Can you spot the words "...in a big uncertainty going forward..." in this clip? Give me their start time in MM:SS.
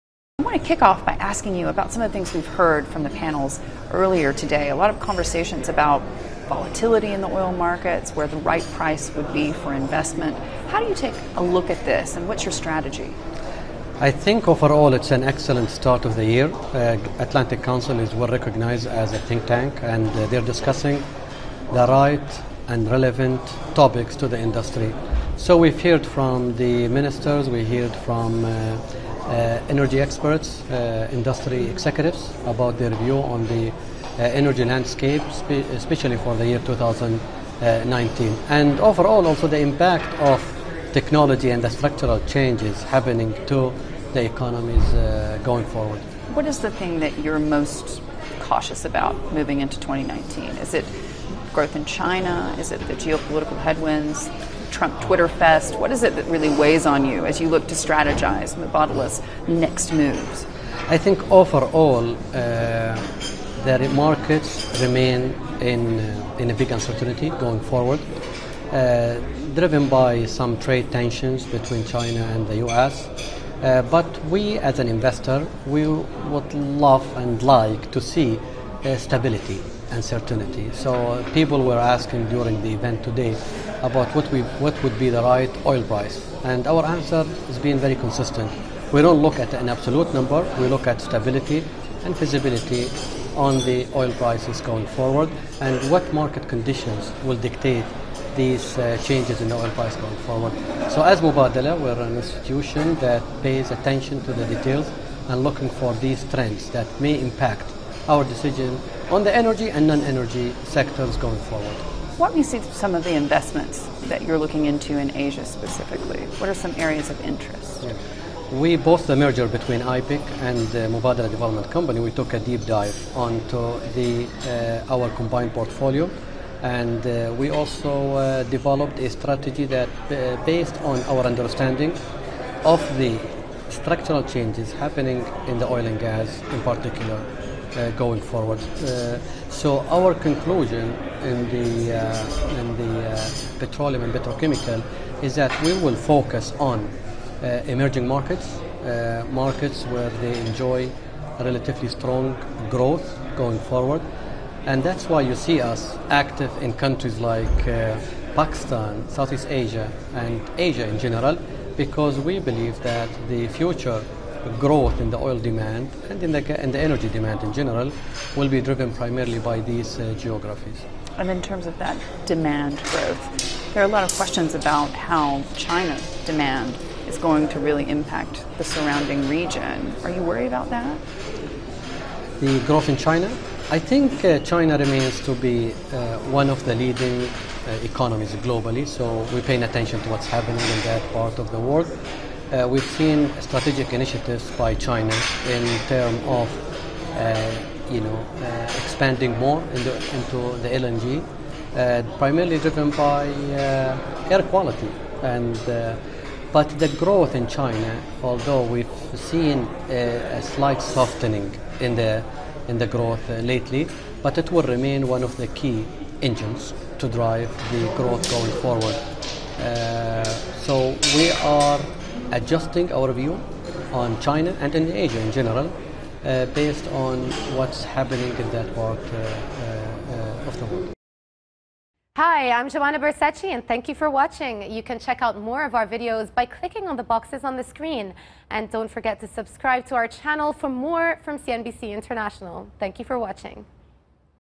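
01:06.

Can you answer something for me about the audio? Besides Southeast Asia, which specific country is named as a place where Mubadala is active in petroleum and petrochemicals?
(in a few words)
Pakistan.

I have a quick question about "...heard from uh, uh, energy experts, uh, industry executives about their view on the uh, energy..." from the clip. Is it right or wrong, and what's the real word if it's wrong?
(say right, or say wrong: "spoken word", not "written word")
right.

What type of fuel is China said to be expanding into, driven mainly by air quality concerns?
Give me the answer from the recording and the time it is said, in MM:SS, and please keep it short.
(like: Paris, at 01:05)
LNG, at 03:20.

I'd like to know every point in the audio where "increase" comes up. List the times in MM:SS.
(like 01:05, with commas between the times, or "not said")
not said.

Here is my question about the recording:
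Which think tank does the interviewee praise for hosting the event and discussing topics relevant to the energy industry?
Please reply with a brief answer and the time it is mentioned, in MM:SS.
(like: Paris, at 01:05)
Atlantic Council, at 00:17.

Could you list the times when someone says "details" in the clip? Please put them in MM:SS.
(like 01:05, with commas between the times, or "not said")
01:44.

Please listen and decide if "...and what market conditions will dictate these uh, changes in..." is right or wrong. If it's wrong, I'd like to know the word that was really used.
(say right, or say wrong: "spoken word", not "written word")
right.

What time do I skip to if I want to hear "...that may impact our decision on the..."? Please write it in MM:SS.
01:46.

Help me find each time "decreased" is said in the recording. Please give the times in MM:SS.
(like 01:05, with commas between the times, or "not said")
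not said.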